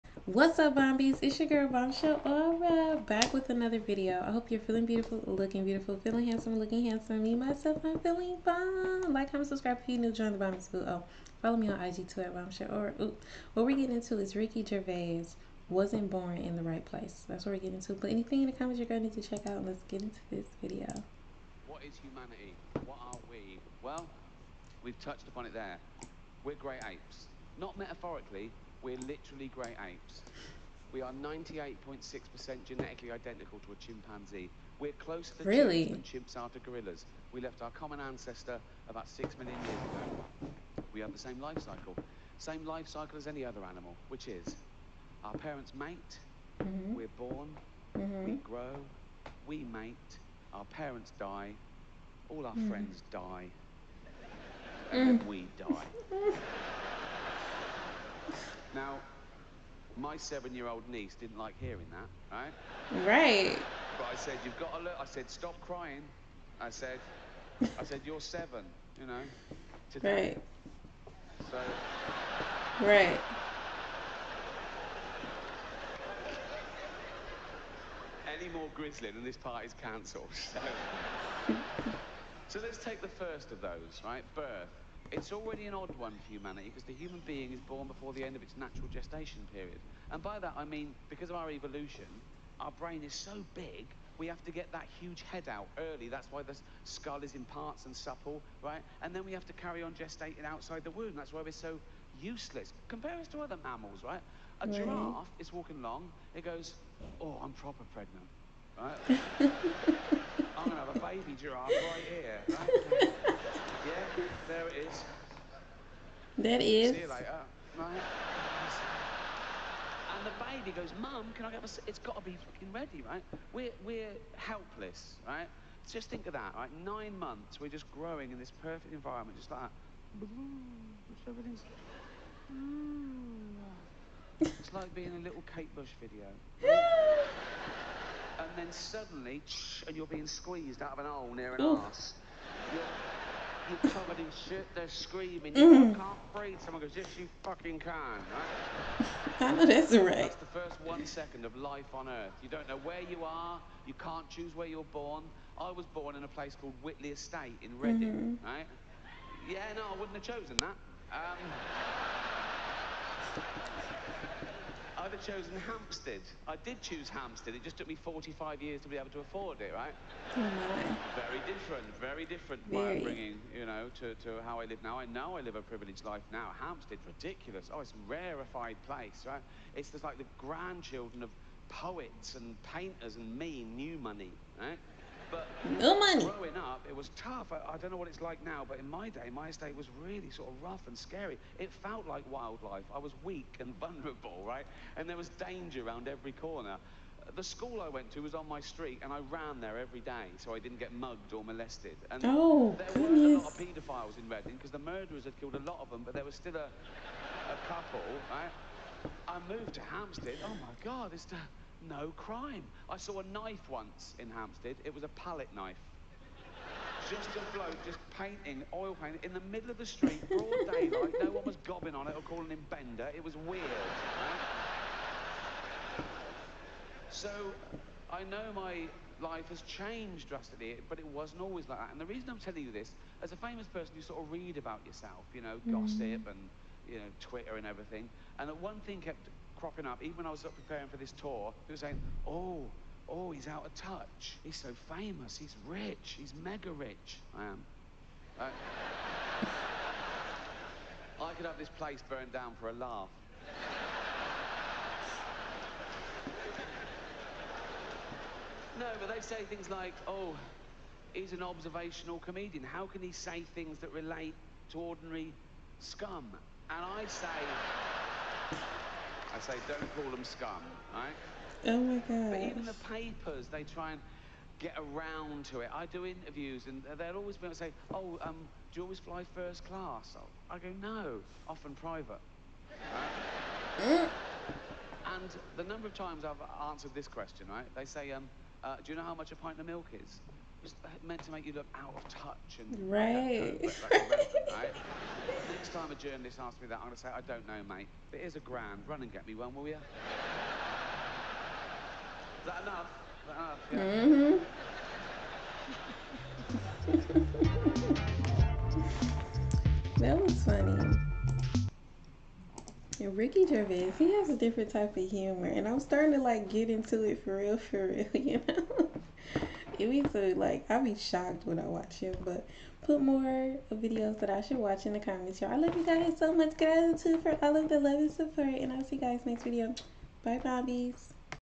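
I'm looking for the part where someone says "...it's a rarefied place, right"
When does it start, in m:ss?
2:57.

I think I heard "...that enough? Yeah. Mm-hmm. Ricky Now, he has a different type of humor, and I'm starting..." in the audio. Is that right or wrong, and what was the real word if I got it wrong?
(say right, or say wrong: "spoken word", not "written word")
wrong: "Gervais", not "Now".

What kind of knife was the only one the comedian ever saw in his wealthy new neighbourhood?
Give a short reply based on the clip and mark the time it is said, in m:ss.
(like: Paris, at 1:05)
palette knife, at 3:35.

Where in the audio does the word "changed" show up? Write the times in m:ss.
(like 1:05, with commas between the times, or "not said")
3:49.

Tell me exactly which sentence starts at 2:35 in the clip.
I was born in a place called Whitley Estate in Reading, mm -hmm.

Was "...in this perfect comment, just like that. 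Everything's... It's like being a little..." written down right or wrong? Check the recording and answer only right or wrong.
wrong.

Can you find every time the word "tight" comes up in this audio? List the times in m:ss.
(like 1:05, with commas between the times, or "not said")
not said.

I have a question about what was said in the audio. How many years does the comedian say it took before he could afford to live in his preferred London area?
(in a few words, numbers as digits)
45.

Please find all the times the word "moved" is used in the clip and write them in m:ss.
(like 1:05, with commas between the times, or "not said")
3:29.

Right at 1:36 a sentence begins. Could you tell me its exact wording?
That's why the skull is in parts and supple, right?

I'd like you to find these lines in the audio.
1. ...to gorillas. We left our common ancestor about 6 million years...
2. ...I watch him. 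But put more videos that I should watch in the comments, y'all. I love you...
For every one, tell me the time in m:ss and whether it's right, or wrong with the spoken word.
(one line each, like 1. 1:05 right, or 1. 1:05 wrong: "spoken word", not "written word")
1. 0:36 right
2. 5:21 right.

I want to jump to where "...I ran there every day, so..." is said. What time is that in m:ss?
3:19.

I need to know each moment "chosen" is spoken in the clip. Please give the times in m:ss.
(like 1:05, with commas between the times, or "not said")
2:40, 2:45.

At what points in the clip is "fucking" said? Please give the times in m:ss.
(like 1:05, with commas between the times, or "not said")
2:02, 2:27.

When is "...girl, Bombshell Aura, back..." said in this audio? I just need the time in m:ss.
0:01.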